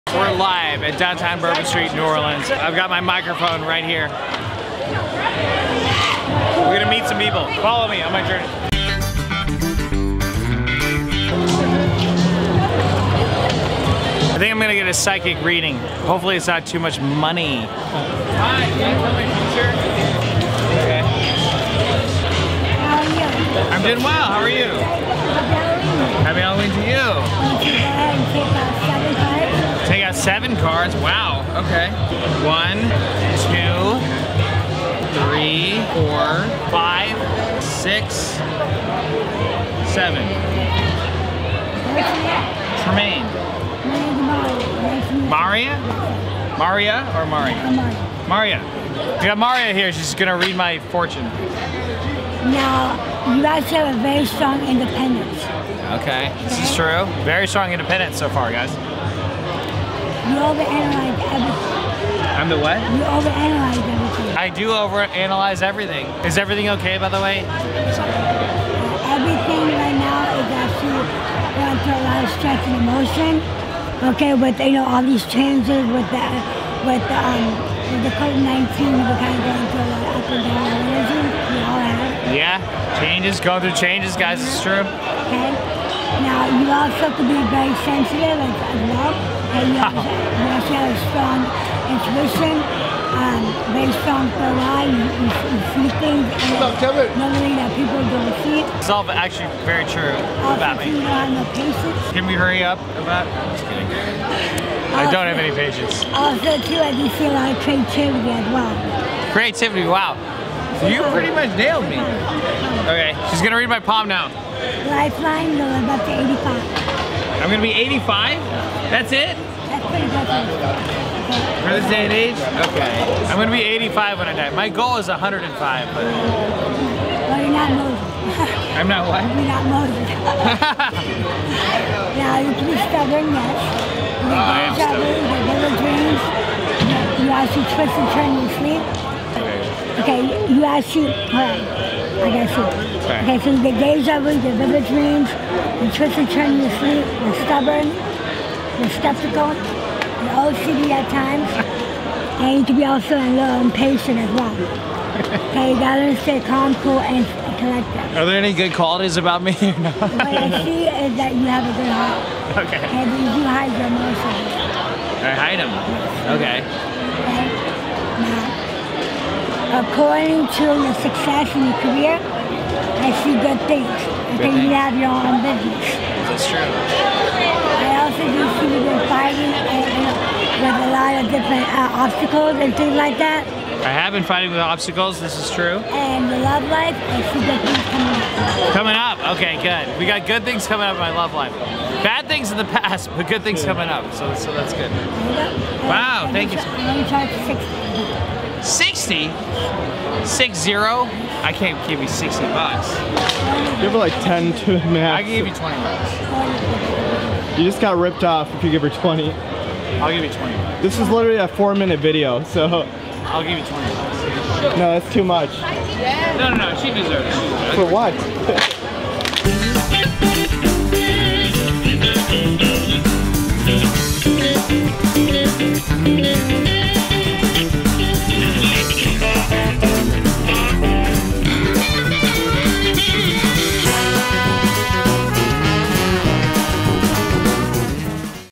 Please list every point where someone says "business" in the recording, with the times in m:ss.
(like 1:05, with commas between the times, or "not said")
2:55.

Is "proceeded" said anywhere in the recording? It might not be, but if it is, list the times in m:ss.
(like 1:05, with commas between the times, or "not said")
not said.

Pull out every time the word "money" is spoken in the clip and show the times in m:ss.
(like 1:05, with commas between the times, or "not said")
0:16.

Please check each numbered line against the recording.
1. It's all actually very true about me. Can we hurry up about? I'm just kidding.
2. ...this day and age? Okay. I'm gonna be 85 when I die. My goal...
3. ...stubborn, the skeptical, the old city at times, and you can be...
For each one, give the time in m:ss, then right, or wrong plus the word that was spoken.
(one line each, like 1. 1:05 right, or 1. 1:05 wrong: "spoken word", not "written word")
1. 1:38 right
2. 2:01 right
3. 2:27 right.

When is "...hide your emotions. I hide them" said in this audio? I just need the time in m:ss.
2:43.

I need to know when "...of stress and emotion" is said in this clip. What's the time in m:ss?
1:12.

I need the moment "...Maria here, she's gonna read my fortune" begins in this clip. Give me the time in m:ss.
0:49.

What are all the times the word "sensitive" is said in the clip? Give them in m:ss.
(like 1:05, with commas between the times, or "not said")
1:27.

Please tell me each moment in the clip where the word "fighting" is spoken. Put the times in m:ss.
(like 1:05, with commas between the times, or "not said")
2:59, 3:04.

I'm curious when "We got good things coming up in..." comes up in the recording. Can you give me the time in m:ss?
3:09.